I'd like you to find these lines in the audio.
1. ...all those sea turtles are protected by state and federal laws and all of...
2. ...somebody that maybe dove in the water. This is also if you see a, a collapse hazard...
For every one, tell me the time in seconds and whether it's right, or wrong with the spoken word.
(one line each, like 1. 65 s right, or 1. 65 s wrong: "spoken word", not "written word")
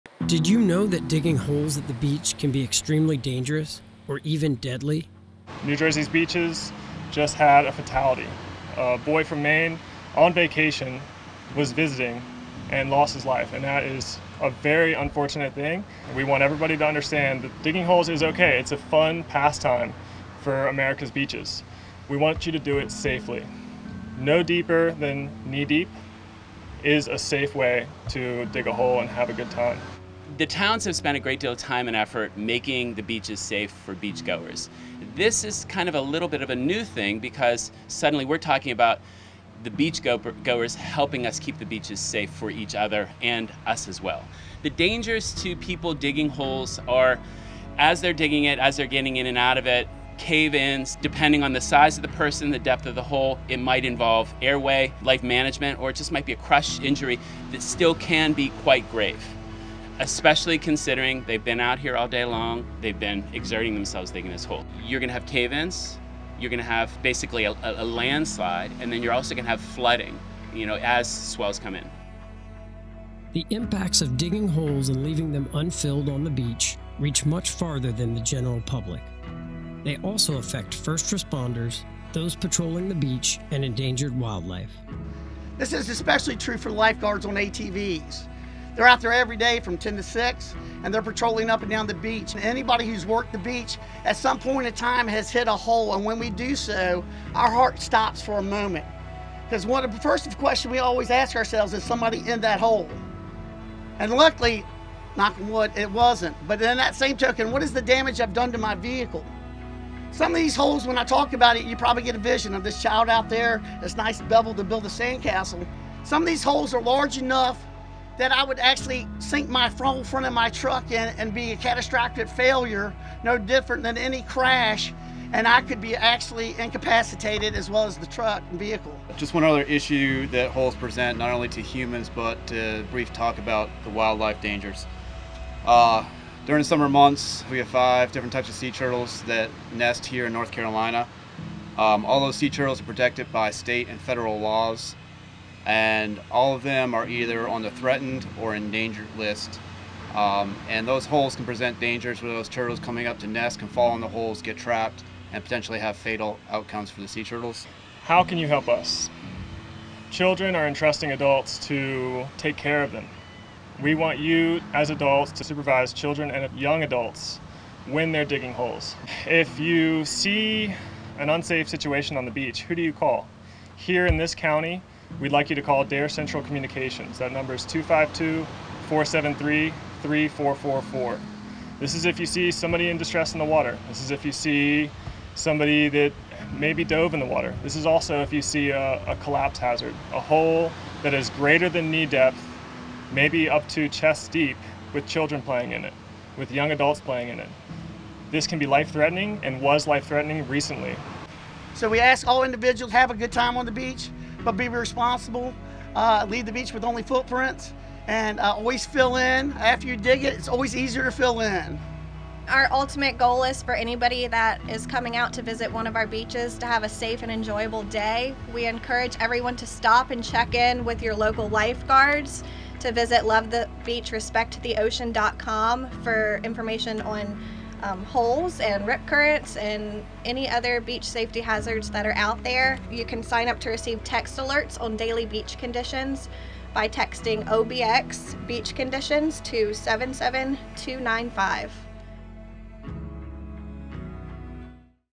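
1. 142 s right
2. 185 s right.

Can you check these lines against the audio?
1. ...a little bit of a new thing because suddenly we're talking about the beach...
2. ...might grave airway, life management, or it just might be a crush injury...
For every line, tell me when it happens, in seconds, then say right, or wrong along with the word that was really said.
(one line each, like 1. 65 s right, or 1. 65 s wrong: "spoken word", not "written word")
1. 35 s right
2. 53 s wrong: "involve", not "grave".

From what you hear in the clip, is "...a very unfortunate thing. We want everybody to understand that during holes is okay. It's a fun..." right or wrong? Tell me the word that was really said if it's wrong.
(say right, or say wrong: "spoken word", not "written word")
wrong: "digging", not "during".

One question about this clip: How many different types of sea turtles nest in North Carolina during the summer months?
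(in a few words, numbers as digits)
5.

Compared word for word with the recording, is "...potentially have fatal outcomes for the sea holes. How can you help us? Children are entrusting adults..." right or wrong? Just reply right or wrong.
wrong.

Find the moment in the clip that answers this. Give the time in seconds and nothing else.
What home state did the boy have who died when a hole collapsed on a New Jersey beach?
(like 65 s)
9 s.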